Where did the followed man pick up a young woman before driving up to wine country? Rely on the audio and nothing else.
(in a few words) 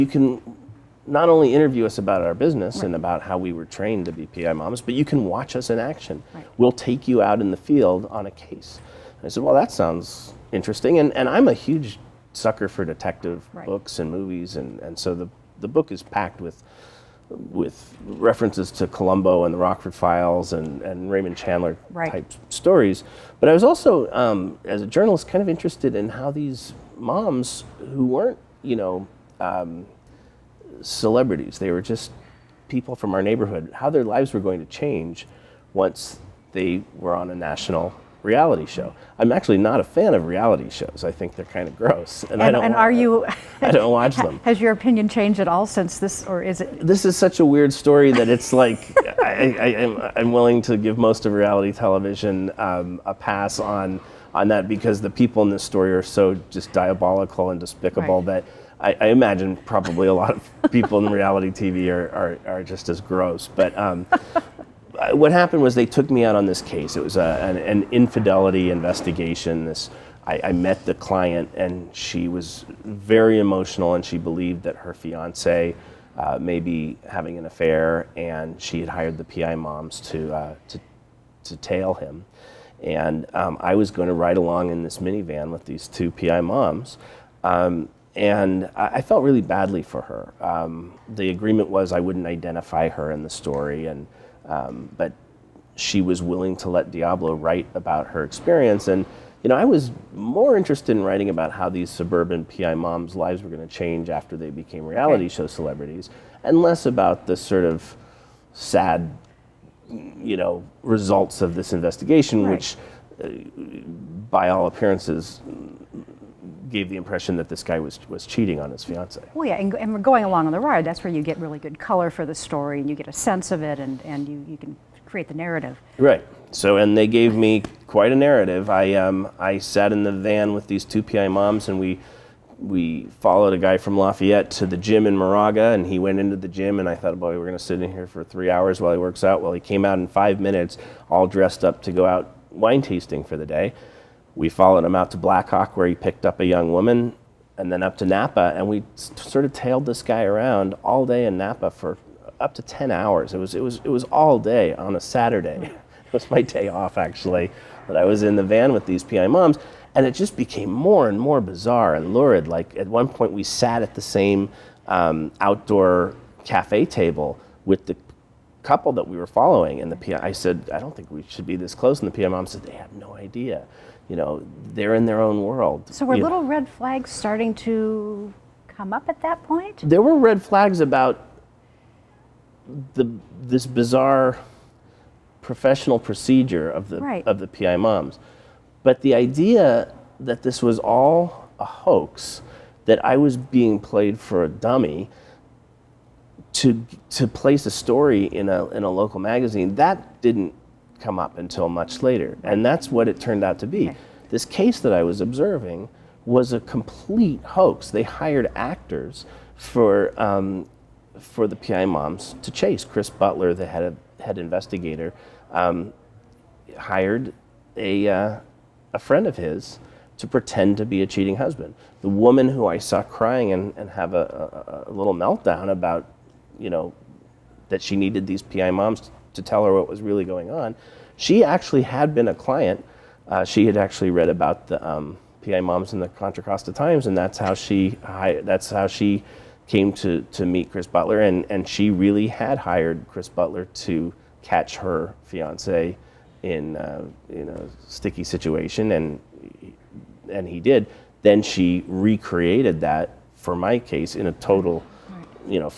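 Blackhawk.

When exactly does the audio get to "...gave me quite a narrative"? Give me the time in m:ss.
2:07.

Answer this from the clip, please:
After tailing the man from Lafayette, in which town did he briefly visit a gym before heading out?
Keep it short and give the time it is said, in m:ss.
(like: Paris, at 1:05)
Moraga, at 2:15.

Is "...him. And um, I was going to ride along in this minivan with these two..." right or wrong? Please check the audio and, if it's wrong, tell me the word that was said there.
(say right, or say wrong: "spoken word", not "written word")
right.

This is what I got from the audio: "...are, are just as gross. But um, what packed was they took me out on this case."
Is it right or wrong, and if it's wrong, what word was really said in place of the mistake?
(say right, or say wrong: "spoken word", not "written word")
wrong: "happened", not "packed".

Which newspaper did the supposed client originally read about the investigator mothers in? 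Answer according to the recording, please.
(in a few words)
Contra Costa Times.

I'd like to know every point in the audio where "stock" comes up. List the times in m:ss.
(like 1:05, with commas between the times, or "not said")
not said.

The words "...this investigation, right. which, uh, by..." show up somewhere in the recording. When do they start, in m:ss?
1:51.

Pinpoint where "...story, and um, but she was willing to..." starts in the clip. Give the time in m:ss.
1:33.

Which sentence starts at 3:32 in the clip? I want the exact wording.
Chris Butler, the head, of, head investigator, um, hired a, uh, a friend of his to pretend to be a cheating husband.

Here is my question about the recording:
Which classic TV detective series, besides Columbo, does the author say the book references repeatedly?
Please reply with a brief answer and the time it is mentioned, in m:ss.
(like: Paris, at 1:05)
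The Rockford Files, at 0:19.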